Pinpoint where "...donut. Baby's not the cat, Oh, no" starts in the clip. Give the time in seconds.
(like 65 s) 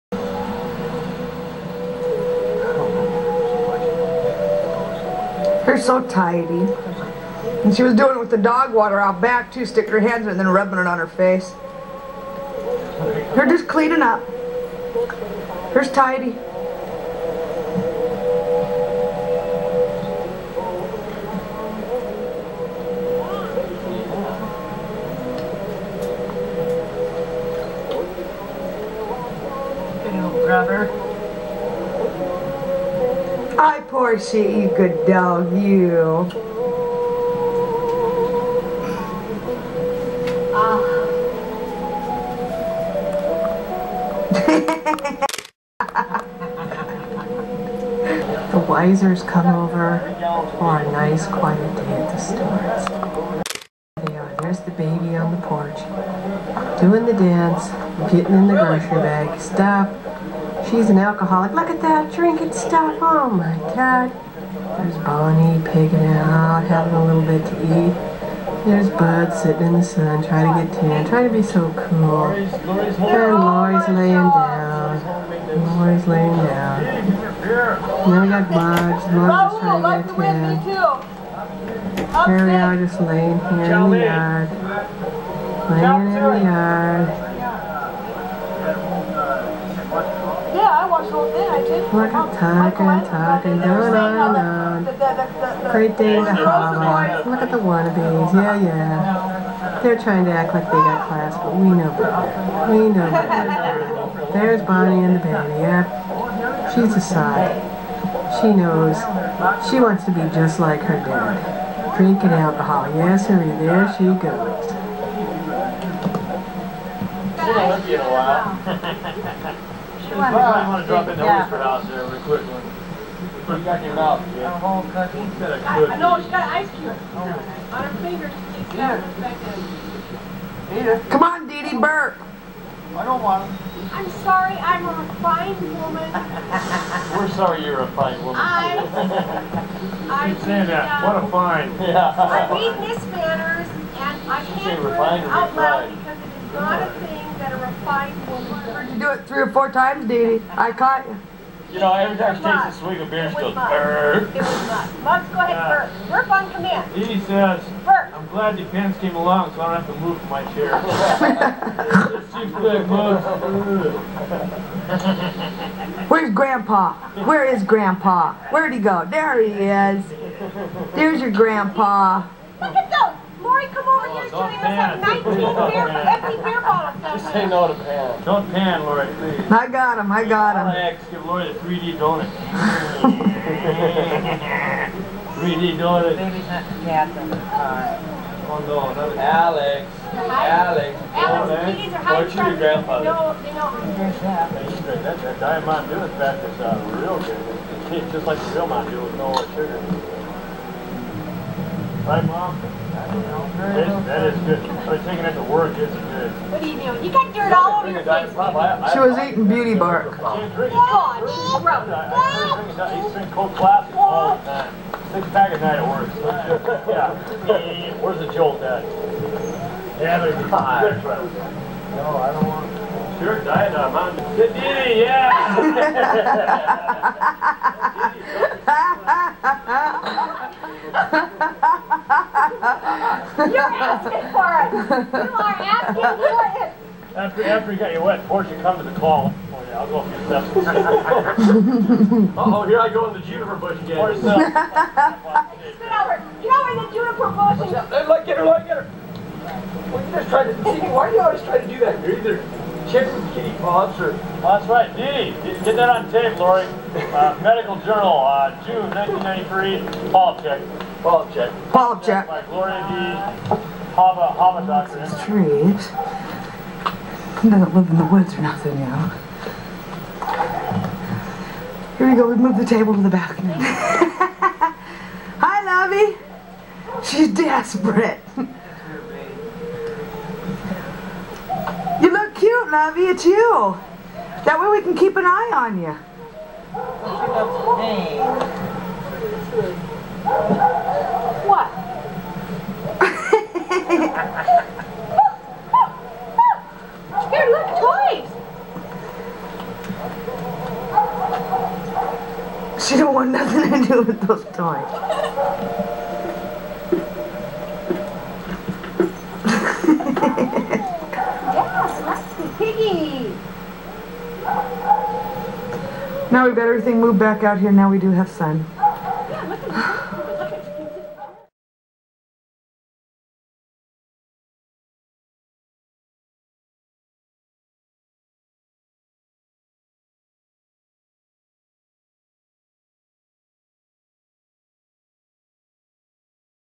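185 s.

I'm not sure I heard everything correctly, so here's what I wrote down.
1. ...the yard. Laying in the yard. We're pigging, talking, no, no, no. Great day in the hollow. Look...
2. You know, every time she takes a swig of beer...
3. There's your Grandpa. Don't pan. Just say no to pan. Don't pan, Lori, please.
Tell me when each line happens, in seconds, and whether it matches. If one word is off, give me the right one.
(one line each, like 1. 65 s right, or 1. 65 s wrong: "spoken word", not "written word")
1. 83 s wrong: "talking", not "pigging"
2. 151 s right
3. 170 s right.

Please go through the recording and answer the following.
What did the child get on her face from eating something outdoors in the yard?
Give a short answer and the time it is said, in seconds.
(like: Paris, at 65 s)
Beauty bark, at 209 s.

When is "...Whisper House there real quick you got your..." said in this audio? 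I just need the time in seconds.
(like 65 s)
121 s.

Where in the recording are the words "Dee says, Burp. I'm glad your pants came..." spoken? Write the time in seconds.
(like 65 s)
156 s.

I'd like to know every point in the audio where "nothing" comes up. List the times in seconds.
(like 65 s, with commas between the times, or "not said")
268 s, 303 s.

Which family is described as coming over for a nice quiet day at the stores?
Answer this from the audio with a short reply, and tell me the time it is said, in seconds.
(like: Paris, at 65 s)
The Wisers, at 48 s.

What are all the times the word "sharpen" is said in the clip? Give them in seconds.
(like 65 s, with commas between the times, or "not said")
not said.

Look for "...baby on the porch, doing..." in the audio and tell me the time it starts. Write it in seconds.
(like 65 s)
54 s.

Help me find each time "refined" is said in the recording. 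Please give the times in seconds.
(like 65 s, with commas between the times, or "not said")
135 s, 144 s.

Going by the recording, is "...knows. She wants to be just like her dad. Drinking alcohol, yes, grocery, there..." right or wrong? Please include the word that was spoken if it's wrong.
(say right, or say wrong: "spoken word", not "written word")
wrong: "hurry", not "grocery".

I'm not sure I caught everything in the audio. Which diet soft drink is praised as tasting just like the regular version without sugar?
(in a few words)
Diet Mountain Dew.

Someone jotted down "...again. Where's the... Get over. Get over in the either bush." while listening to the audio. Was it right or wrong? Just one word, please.
wrong.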